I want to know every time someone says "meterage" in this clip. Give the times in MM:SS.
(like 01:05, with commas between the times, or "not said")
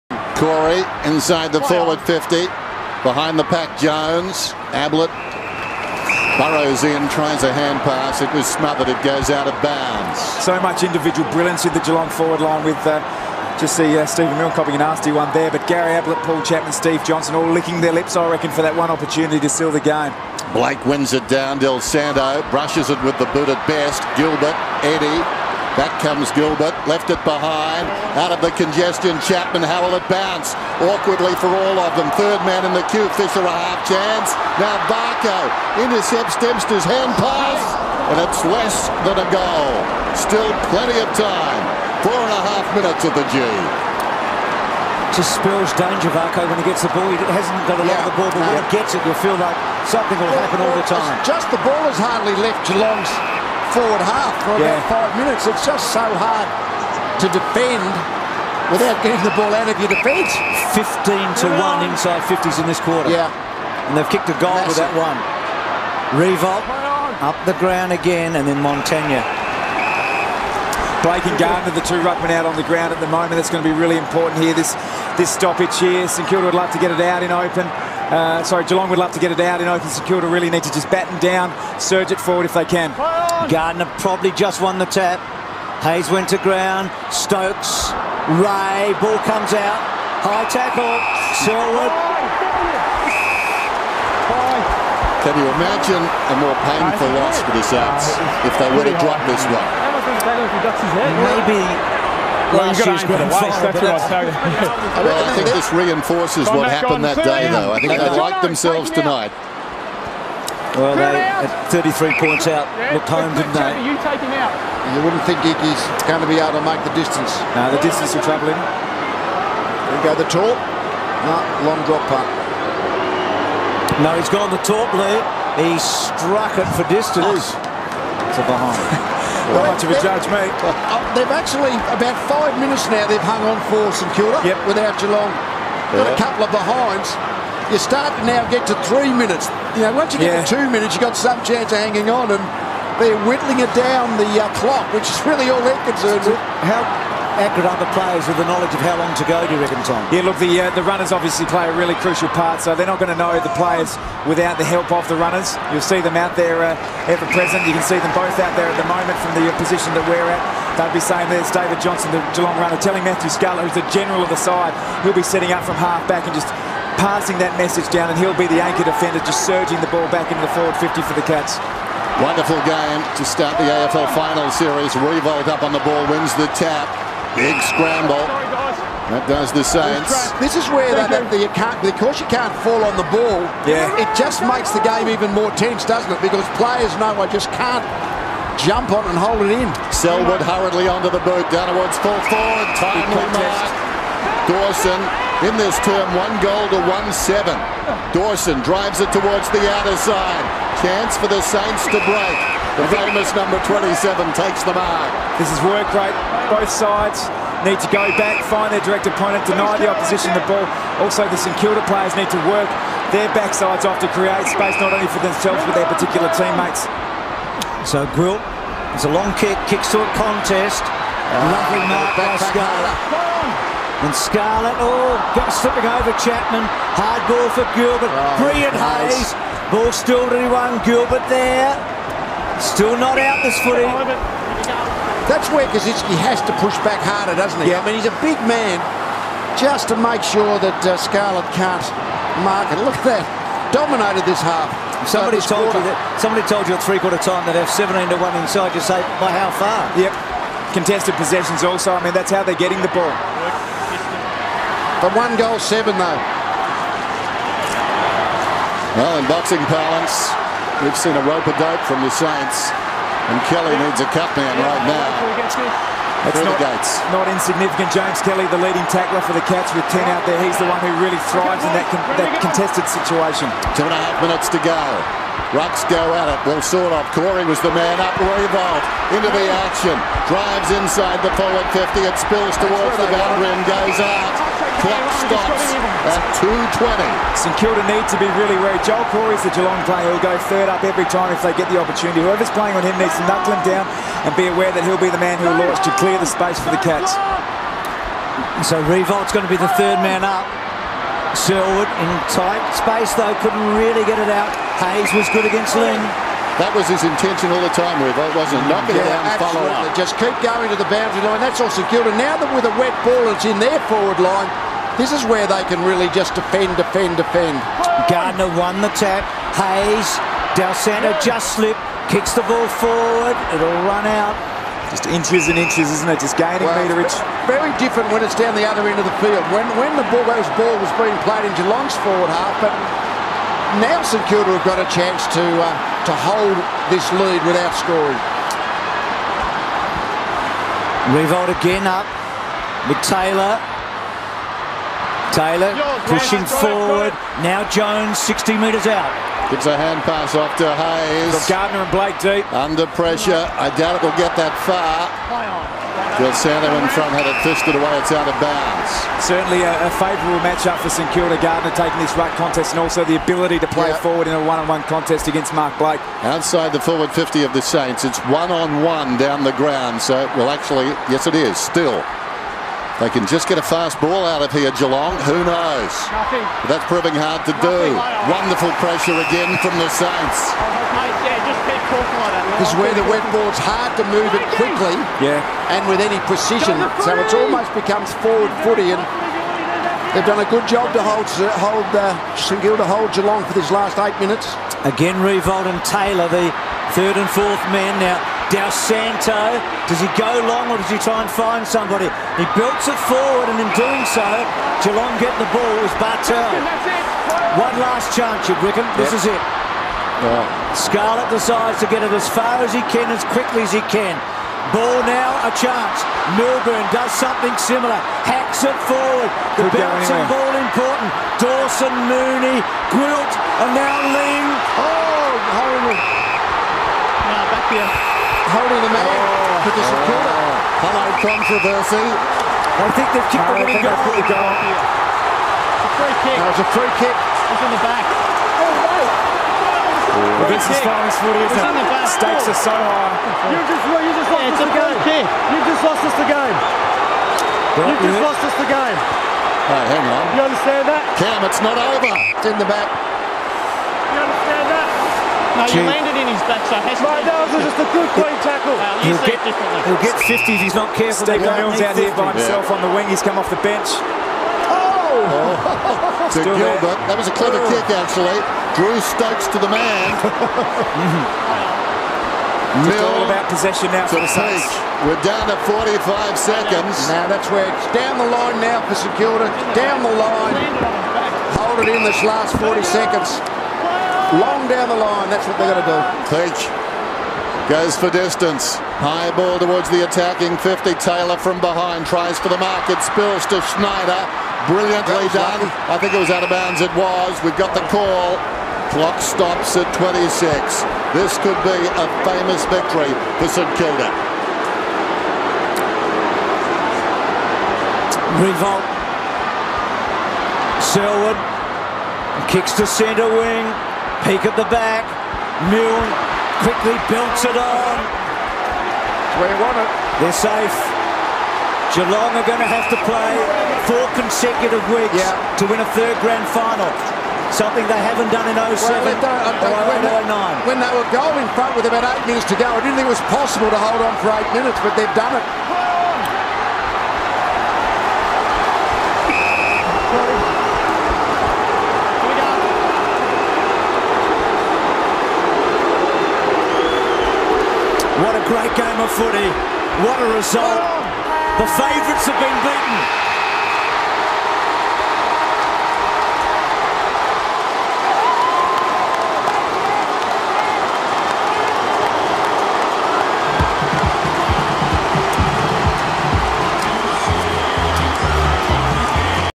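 05:26.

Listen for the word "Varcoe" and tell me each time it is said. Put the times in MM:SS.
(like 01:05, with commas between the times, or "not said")
00:34, 00:46.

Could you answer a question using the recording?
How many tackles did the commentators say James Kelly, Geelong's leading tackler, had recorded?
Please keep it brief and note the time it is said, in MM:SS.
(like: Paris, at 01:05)
10, at 04:29.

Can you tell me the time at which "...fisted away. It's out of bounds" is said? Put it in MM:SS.
05:57.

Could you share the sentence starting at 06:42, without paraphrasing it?
He belts it forward and in doing so, Geelong get the ball as Bartel.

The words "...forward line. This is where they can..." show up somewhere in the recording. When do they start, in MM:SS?
05:13.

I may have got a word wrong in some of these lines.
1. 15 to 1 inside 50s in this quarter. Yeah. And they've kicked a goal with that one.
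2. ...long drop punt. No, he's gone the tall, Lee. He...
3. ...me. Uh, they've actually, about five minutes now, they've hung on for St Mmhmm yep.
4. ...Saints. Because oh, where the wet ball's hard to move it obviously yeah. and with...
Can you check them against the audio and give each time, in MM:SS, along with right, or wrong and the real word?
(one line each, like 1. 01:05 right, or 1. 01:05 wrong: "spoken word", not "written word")
1. 01:00 right
2. 02:01 right
3. 02:10 wrong: "Kilda", not "Mmhmm"
4. 06:19 wrong: "quickly", not "obviously".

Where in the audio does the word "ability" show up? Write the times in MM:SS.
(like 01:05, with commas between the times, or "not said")
06:03.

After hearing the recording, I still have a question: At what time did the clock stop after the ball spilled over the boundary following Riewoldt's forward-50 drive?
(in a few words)
2.20.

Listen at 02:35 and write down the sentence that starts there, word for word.
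You'll see them out there uh, ever present.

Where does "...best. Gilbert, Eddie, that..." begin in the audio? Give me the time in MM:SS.
00:23.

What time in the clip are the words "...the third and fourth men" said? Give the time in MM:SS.
06:36.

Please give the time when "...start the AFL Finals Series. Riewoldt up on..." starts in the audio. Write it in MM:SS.
02:53.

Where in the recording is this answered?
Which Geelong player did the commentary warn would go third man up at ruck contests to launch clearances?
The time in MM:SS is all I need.
04:48.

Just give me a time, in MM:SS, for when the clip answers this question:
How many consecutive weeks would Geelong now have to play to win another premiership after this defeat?
08:43.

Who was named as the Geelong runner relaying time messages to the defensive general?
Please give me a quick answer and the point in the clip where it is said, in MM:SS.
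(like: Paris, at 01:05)
David Johnson, at 02:41.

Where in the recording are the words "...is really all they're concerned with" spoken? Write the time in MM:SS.
02:25.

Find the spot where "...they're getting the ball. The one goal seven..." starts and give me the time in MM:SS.
04:12.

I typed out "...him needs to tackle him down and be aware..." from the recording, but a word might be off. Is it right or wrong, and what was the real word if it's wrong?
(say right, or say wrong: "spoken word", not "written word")
wrong: "knuckle", not "tackle".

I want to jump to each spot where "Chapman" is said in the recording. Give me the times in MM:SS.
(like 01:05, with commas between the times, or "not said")
00:16, 00:29, 03:46.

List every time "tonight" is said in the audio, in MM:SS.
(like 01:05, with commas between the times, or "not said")
01:48.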